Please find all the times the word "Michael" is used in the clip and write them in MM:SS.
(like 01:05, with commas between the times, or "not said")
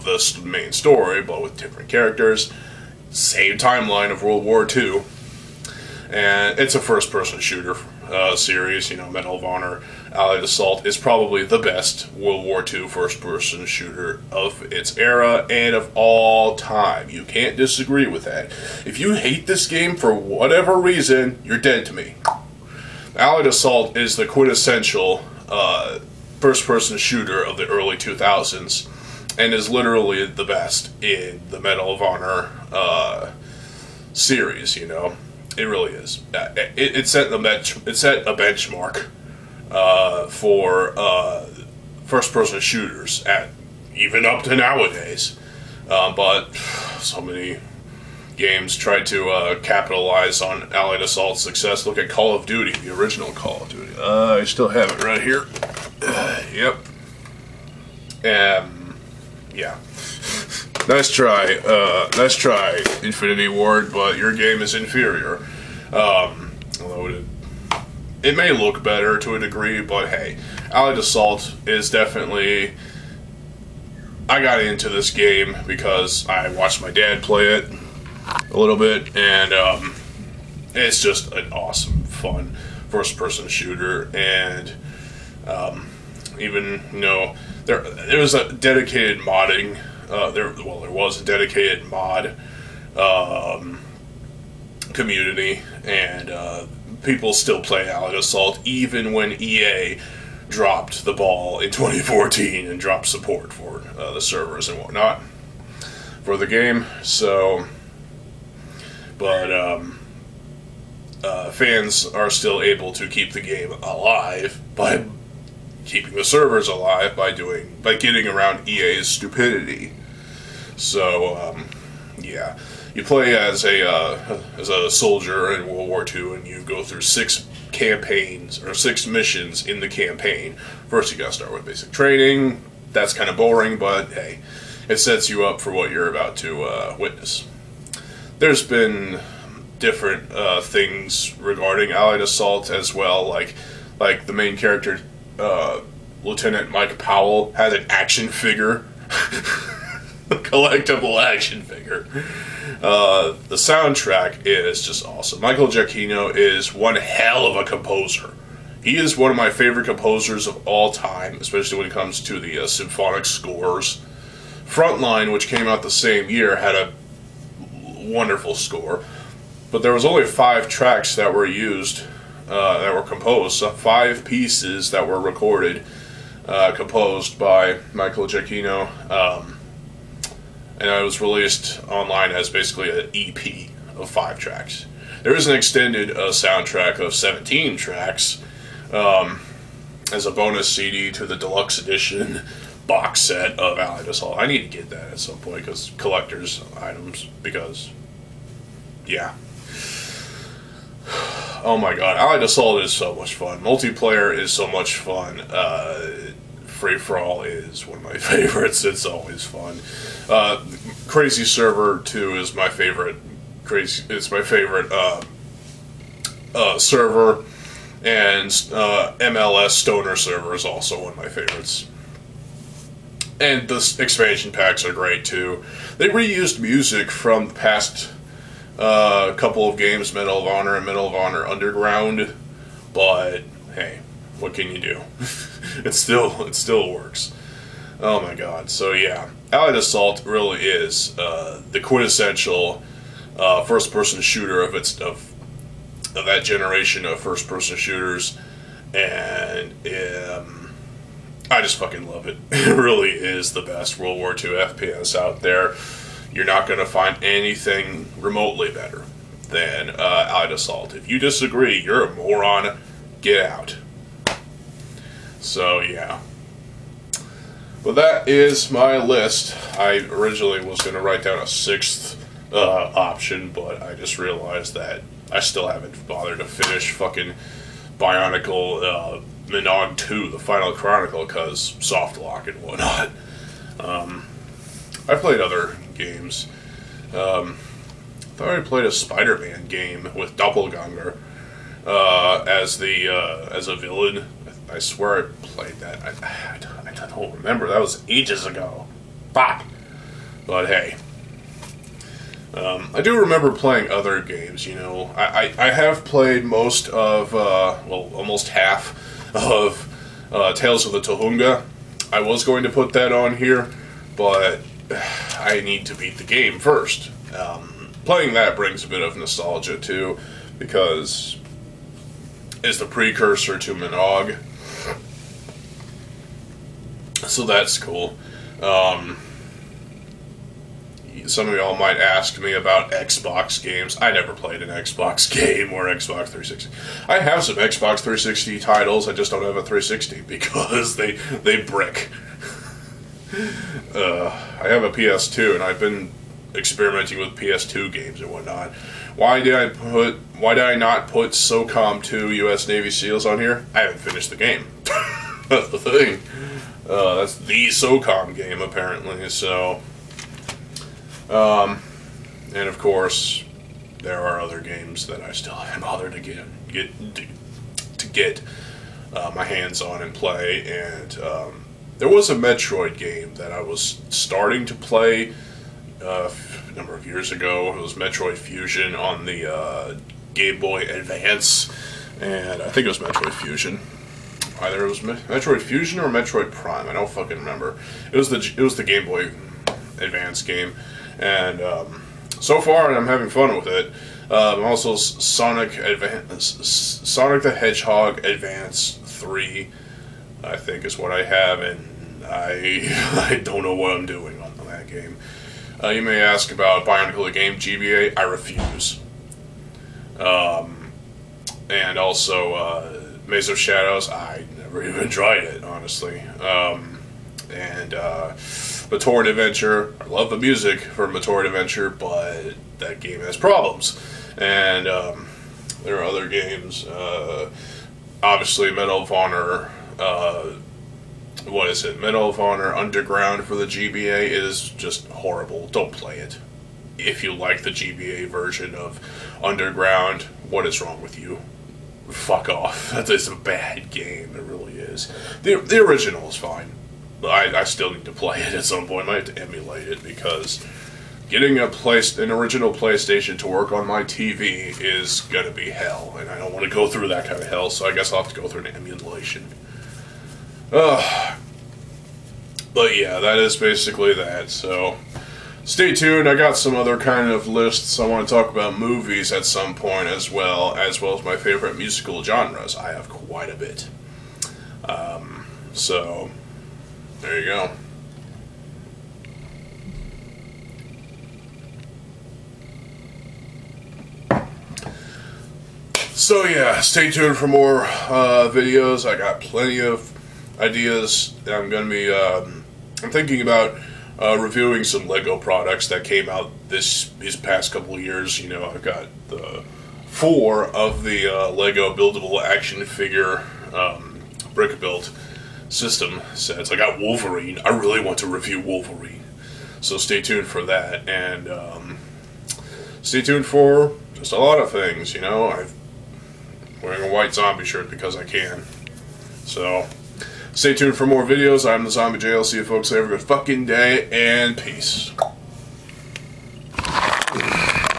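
02:35, 02:57.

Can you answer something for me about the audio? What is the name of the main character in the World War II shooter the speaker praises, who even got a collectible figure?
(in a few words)
Lieutenant Mike Powell.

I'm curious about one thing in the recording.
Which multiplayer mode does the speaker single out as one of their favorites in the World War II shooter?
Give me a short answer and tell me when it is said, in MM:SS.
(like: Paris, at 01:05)
Free for All, at 03:26.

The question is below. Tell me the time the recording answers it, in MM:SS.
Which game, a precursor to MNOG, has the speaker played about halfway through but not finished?
05:10.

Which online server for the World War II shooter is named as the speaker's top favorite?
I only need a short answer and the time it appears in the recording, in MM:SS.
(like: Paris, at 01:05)
Crazy Server 2, at 03:31.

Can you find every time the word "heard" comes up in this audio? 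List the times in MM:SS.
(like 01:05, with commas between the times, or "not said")
not said.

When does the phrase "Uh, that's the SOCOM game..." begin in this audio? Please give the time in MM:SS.
05:56.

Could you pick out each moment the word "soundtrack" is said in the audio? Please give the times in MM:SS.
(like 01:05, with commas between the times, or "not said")
02:33, 03:06.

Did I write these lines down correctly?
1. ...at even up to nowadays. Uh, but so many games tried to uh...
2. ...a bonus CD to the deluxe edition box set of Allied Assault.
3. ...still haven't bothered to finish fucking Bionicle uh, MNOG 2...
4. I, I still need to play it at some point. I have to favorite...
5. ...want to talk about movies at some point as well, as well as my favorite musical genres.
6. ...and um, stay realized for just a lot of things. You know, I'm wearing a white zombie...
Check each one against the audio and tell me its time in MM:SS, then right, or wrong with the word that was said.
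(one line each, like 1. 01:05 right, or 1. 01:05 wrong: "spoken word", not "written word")
1. 00:43 right
2. 03:10 right
3. 04:35 right
4. 07:27 wrong: "emulate", not "favorite"
5. 07:48 right
6. 08:31 wrong: "tuned", not "realized".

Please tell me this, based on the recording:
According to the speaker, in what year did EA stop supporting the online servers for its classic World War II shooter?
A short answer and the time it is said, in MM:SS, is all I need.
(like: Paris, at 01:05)
2014, at 01:41.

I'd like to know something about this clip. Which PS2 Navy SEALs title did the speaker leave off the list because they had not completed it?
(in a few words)
SOCOM 2.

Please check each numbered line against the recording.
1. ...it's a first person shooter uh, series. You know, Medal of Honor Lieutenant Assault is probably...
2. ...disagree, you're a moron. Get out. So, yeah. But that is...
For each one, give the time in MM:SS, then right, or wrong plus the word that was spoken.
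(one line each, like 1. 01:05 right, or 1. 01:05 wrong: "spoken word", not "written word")
1. 00:06 wrong: "Allied", not "Lieutenant"
2. 04:21 right.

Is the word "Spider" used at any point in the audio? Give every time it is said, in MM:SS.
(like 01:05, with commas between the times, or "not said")
04:48.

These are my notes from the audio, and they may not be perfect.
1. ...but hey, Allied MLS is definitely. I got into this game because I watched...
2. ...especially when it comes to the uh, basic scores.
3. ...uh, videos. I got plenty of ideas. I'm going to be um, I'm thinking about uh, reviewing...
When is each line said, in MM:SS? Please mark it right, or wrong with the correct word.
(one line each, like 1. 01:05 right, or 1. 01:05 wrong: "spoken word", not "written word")
1. 01:09 wrong: "Assault", not "MLS"
2. 02:41 wrong: "symphonic", not "basic"
3. 08:07 right.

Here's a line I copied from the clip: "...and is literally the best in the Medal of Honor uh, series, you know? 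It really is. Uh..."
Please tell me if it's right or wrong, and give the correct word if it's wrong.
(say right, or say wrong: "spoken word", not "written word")
right.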